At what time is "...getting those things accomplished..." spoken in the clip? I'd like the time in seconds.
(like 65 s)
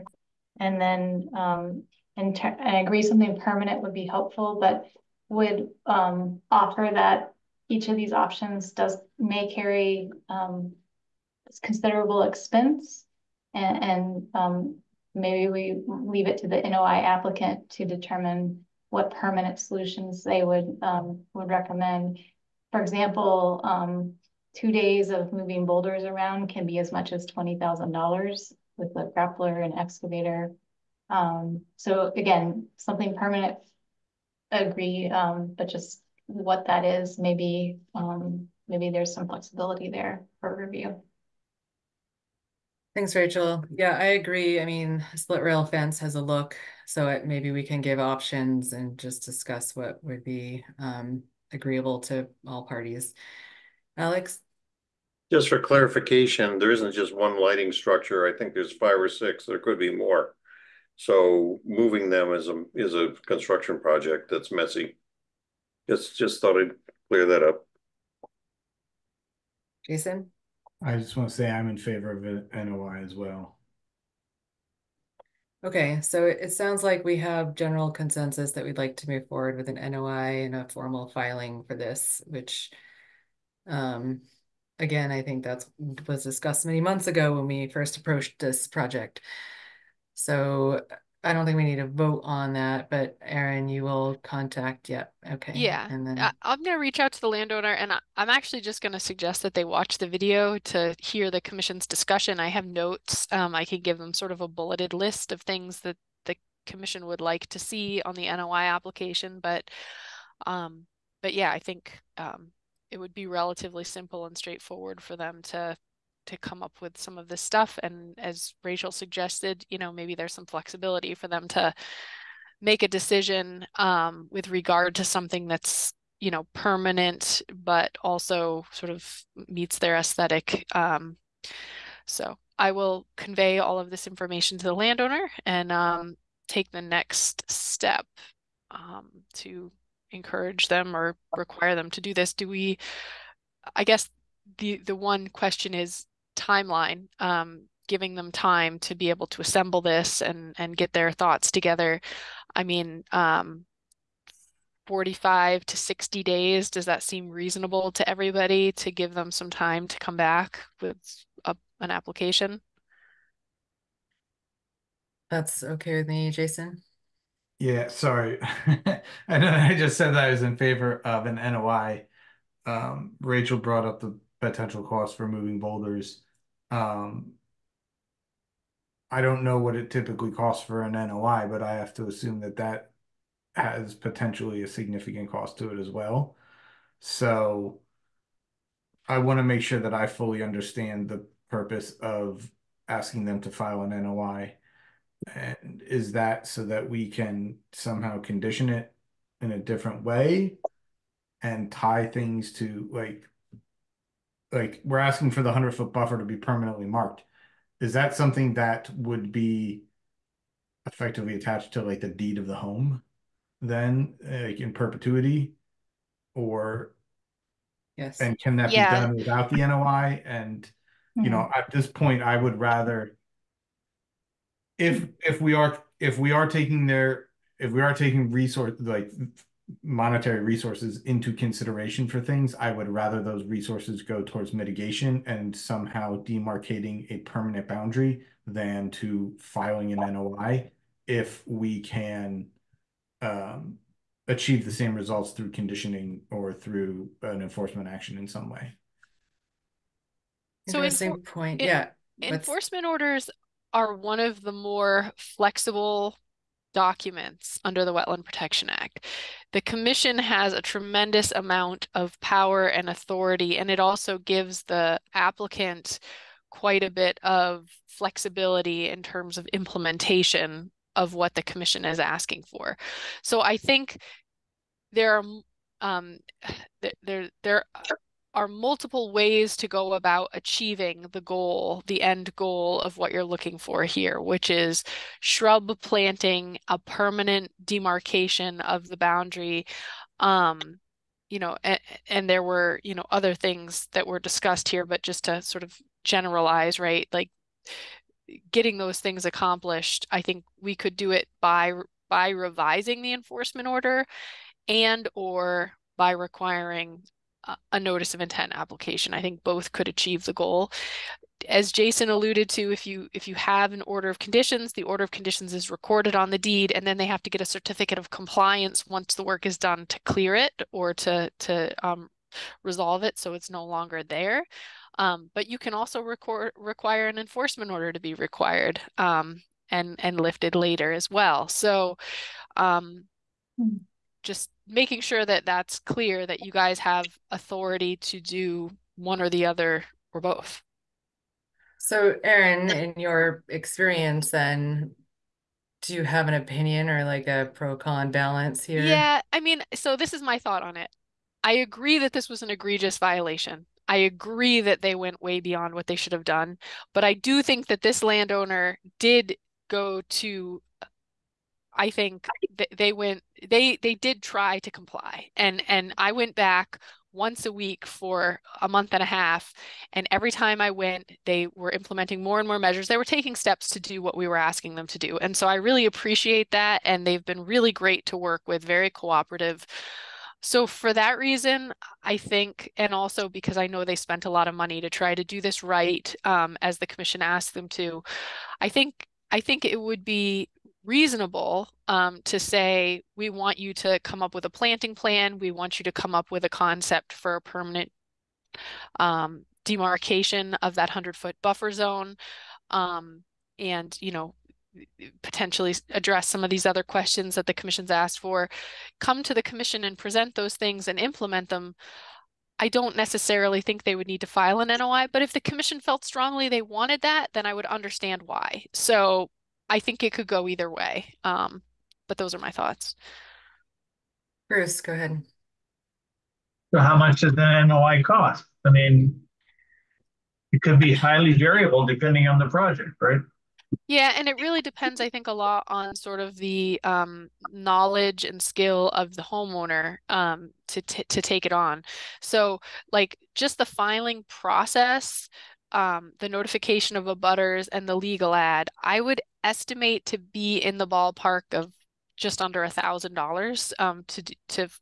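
298 s.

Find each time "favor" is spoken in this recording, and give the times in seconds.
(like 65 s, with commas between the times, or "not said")
71 s, 170 s.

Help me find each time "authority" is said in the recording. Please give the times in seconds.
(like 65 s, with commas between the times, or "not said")
262 s, 337 s.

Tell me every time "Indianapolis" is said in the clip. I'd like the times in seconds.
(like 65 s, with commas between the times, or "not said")
not said.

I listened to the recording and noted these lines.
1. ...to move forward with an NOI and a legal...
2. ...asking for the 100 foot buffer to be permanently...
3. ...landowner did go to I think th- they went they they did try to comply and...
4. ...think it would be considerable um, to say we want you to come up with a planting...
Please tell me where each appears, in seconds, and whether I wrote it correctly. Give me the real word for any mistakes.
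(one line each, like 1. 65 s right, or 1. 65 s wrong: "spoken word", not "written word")
1. 78 s wrong: "formal", not "legal"
2. 204 s right
3. 358 s right
4. 389 s wrong: "reasonable", not "considerable".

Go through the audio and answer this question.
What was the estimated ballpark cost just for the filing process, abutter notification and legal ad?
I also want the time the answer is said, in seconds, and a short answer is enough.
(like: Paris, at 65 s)
just under $1,000, at 452 s.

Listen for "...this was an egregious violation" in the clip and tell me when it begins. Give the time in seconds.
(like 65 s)
352 s.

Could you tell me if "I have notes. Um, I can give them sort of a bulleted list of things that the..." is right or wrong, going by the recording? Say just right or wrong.
right.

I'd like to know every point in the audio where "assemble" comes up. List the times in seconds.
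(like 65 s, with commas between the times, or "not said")
149 s.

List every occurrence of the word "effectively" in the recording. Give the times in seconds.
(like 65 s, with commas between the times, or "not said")
210 s.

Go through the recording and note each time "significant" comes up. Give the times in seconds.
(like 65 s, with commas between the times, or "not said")
184 s.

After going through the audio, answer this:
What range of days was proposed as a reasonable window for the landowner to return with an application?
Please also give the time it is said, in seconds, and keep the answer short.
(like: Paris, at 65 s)
45 to 60 days, at 154 s.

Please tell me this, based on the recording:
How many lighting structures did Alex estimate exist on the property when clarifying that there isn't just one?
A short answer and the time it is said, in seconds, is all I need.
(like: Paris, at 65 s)
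five or six, at 58 s.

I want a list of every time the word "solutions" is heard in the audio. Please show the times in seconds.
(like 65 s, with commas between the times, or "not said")
19 s.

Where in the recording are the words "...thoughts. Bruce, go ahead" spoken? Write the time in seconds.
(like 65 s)
422 s.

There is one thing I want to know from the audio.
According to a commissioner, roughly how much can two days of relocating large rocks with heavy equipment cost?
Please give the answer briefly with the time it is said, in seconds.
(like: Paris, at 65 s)
$20,000, at 27 s.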